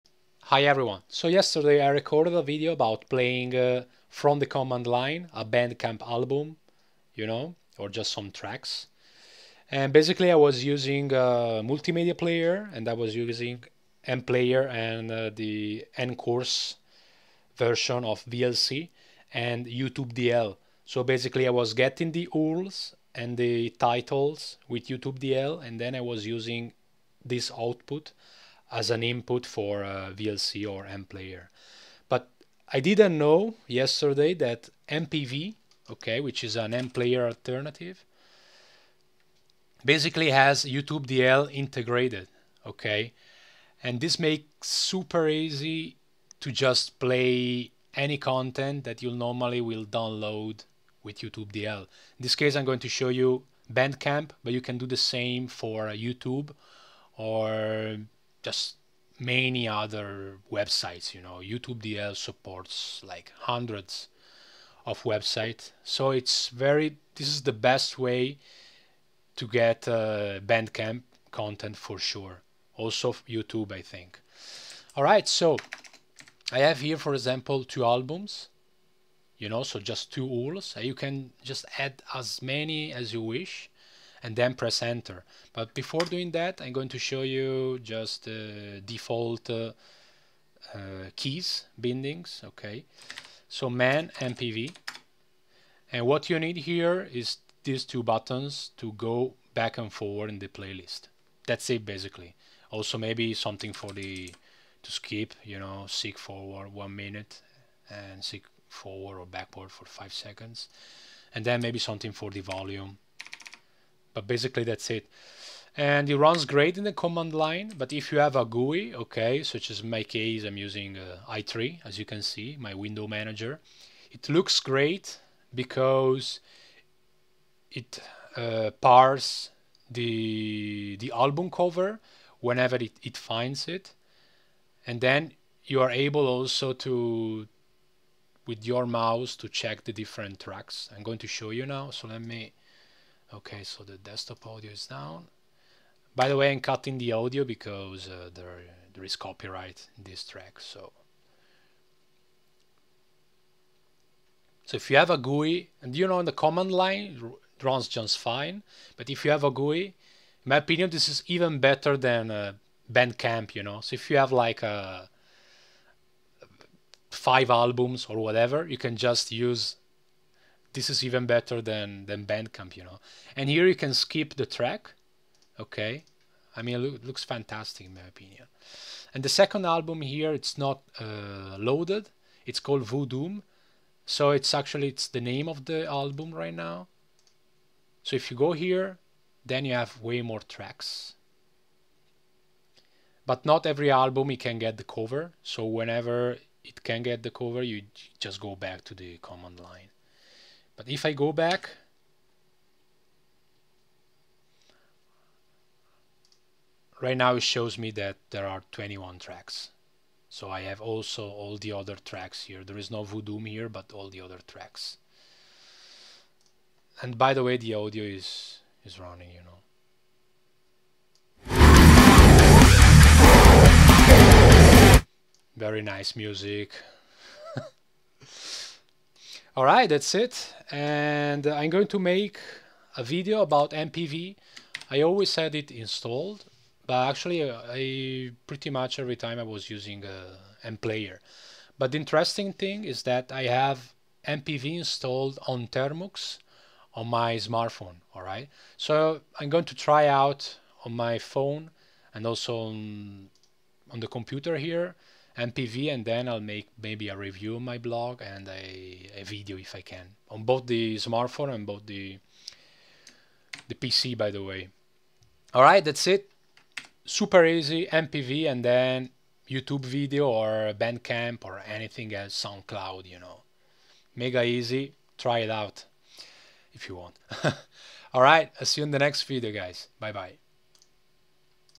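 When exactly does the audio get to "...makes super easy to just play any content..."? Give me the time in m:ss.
0:44.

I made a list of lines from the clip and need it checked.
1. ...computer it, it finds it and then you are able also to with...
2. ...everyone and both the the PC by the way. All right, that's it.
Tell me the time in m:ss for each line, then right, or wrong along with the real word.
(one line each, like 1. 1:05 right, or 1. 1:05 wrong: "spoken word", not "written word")
1. 2:12 wrong: "whenever", not "computer"
2. 4:20 wrong: "smartphone", not "everyone".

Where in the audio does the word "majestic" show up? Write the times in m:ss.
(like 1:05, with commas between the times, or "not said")
not said.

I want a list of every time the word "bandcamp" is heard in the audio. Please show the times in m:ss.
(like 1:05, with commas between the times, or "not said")
0:05, 0:53, 1:10, 2:42, 2:52, 4:30.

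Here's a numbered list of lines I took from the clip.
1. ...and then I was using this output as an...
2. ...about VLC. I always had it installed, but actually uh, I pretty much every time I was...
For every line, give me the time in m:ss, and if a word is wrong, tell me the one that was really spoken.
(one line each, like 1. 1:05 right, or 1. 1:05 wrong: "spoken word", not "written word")
1. 0:25 right
2. 3:53 wrong: "MPV", not "VLC".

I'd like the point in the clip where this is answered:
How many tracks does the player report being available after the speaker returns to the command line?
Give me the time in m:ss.
3:28.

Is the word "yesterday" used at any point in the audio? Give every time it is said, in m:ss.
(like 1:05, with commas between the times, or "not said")
0:01, 0:33.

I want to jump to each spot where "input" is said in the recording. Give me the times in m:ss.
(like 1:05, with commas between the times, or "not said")
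0:29.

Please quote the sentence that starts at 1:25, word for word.
But before doing that, I'm going to show you just the uh, default uh, uh, keys, bindings, okay?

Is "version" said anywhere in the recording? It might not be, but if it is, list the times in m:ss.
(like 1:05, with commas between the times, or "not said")
0:17.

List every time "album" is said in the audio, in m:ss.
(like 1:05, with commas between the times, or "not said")
0:06, 1:17, 2:11, 2:47, 2:59, 3:05, 3:13.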